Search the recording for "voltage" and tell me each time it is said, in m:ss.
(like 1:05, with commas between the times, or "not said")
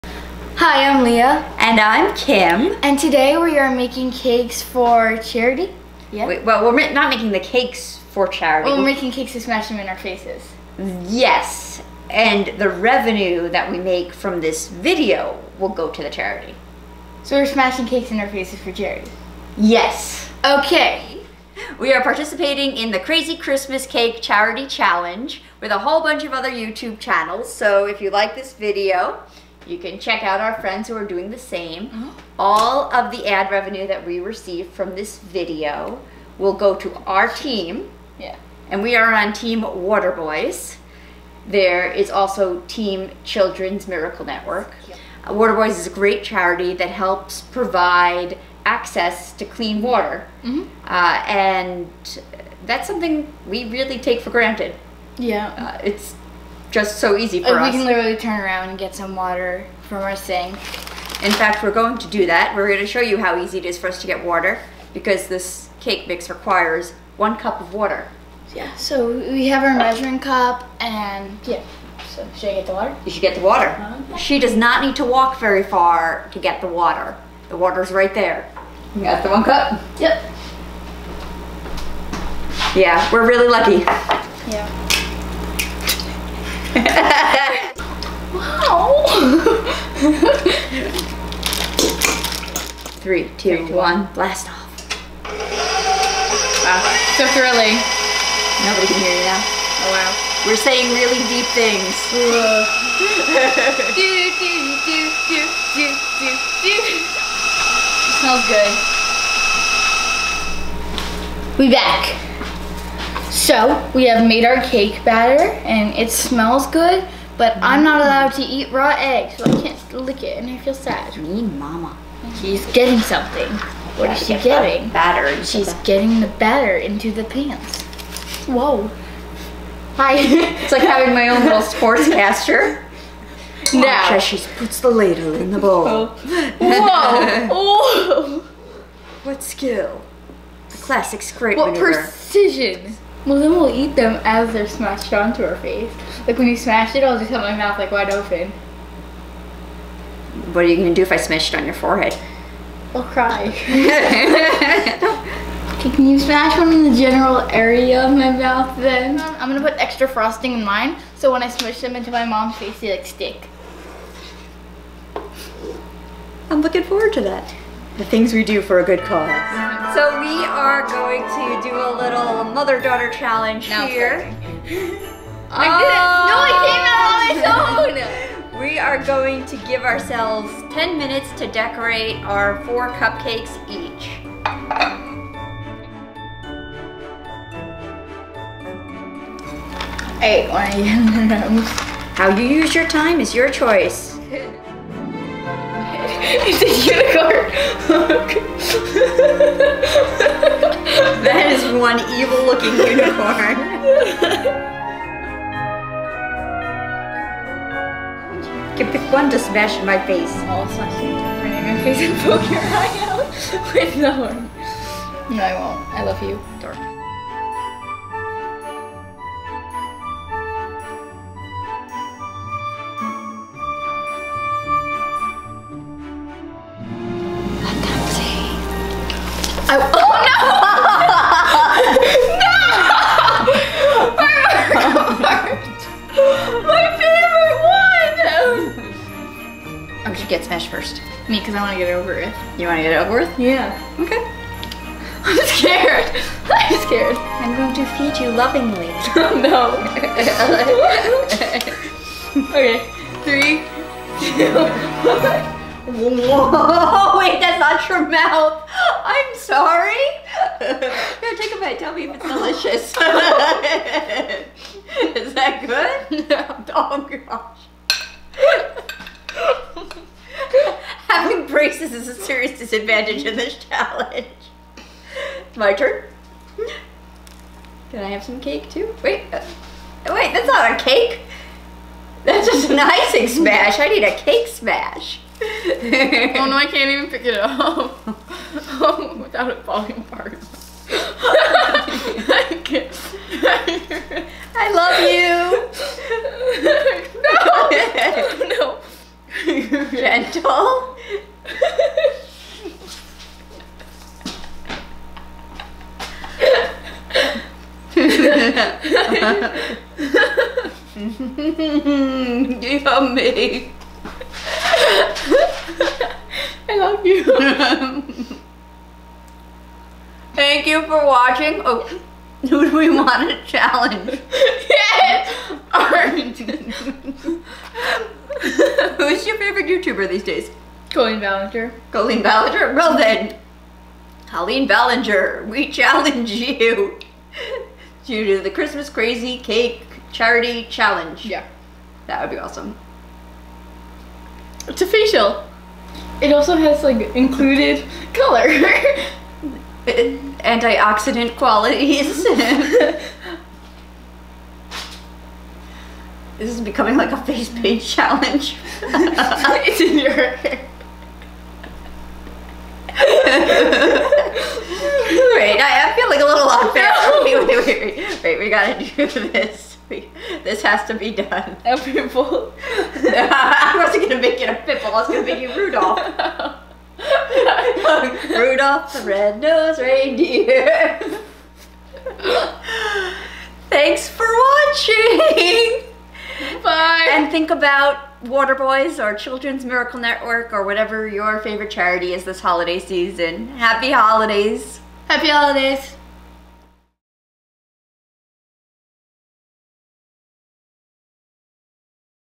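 not said.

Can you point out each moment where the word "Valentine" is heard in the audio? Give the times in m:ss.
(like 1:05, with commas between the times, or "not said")
not said.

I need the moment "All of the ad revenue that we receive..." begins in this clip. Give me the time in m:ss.
0:32.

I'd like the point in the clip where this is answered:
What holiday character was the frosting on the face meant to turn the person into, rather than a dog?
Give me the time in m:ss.
6:18.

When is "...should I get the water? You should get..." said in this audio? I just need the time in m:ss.
1:12.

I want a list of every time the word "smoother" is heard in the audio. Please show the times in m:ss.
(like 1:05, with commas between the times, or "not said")
not said.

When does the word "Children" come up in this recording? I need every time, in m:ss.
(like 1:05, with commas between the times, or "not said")
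0:43, 6:29.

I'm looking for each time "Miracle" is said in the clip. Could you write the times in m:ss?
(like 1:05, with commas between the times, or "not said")
0:43, 6:29.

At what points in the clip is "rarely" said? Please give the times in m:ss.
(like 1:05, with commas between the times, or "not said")
not said.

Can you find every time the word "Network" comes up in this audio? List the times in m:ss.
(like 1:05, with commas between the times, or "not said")
0:44, 6:29.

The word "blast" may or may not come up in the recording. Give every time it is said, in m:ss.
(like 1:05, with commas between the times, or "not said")
1:34.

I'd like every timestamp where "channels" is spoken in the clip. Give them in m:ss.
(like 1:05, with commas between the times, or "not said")
0:26.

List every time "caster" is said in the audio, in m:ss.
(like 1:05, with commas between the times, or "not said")
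2:12.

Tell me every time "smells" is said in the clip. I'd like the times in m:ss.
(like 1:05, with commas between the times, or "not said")
1:48, 1:56.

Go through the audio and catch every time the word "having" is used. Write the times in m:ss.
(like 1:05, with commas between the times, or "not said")
2:10, 4:31.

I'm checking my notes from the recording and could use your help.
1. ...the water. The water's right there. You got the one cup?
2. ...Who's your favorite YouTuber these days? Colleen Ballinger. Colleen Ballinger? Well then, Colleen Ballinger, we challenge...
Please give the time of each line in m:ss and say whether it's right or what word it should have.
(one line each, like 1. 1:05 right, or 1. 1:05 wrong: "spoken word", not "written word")
1. 1:16 right
2. 5:28 right.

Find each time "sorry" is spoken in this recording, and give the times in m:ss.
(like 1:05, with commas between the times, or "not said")
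4:19.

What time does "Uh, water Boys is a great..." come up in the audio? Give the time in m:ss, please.
0:45.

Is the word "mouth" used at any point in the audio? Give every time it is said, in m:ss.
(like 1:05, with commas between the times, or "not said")
2:27, 2:38, 4:18.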